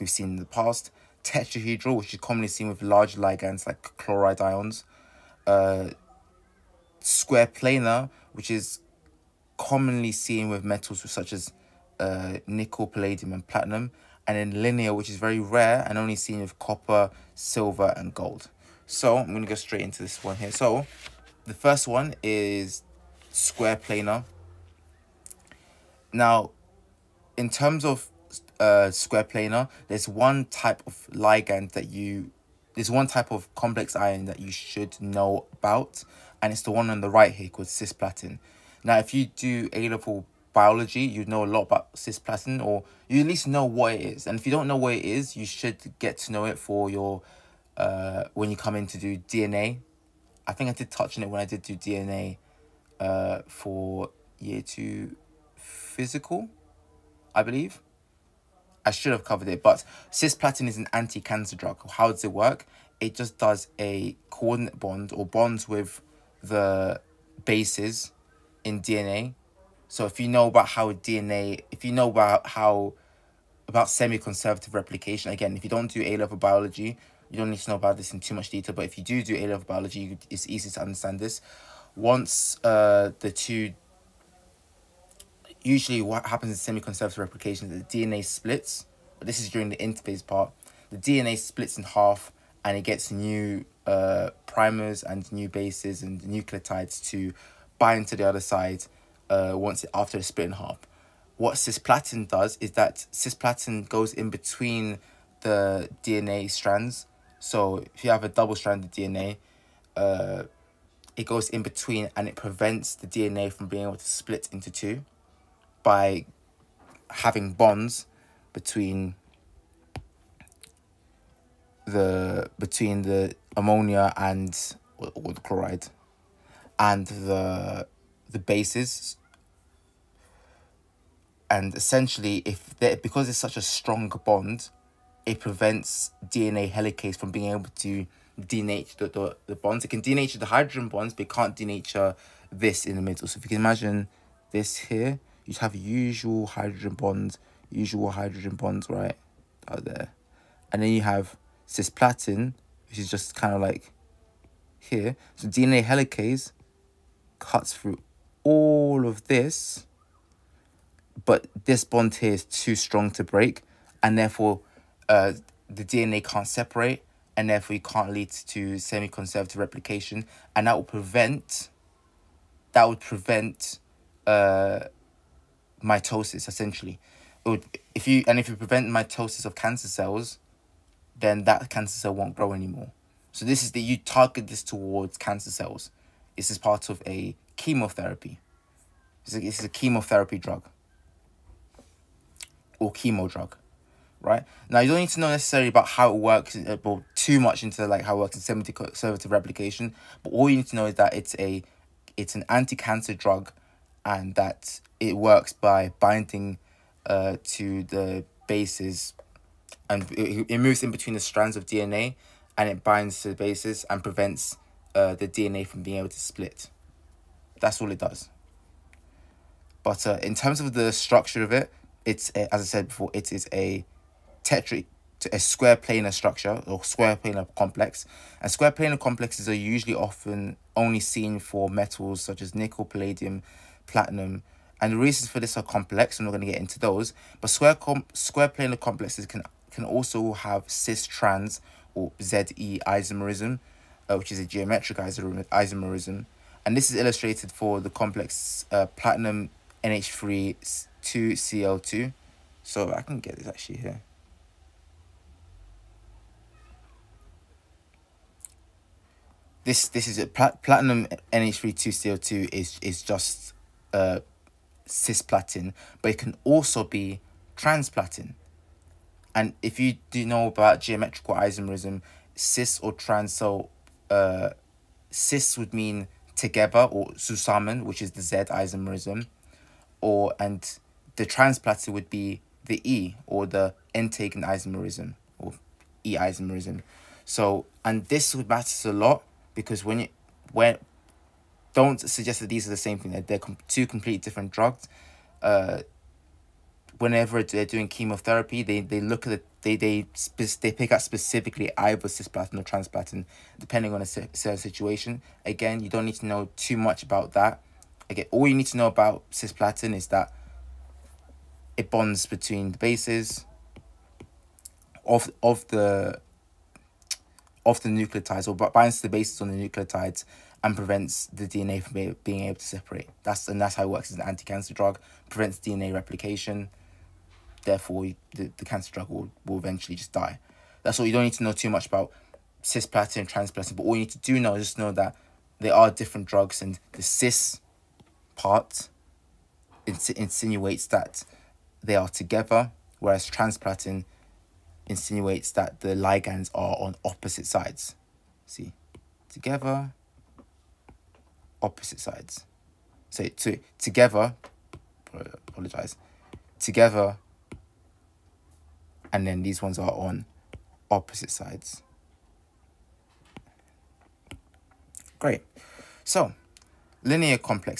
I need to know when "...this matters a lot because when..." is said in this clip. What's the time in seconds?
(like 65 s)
288 s.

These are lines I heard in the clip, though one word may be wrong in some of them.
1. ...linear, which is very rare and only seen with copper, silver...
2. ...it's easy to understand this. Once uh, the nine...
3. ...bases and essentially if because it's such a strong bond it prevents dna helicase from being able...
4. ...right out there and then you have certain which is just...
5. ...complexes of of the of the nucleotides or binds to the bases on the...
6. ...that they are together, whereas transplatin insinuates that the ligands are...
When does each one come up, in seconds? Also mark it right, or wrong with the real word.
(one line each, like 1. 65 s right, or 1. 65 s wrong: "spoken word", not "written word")
1. 14 s right
2. 80 s wrong: "two", not "nine"
3. 128 s right
4. 148 s wrong: "cisplatin", not "certain"
5. 312 s wrong: "bases", not "complexes"
6. 340 s right.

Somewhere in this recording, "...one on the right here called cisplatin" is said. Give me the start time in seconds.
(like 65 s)
36 s.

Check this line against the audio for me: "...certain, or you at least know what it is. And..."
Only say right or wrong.
wrong.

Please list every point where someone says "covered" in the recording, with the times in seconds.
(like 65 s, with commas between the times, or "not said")
59 s.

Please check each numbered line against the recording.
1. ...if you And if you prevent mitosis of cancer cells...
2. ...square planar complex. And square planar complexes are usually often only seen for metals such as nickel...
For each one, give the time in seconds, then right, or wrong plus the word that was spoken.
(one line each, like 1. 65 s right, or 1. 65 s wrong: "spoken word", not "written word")
1. 177 s right
2. 226 s right.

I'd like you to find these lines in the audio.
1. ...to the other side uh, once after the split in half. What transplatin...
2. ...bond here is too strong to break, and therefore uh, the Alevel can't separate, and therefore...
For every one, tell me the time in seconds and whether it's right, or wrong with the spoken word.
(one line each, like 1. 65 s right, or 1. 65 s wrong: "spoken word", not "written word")
1. 98 s wrong: "cisplatin", not "transplatin"
2. 161 s wrong: "DNA", not "Alevel".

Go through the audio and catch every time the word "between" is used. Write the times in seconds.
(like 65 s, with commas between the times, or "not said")
104 s, 111 s, 118 s, 122 s, 210 s, 312 s.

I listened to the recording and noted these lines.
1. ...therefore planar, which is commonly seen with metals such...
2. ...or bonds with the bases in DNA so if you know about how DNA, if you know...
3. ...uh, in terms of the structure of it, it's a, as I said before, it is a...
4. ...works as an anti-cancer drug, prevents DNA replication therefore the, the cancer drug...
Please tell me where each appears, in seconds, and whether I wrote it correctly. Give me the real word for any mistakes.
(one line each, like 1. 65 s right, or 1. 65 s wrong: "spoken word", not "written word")
1. 6 s wrong: "square", not "therefore"
2. 65 s right
3. 220 s right
4. 323 s right.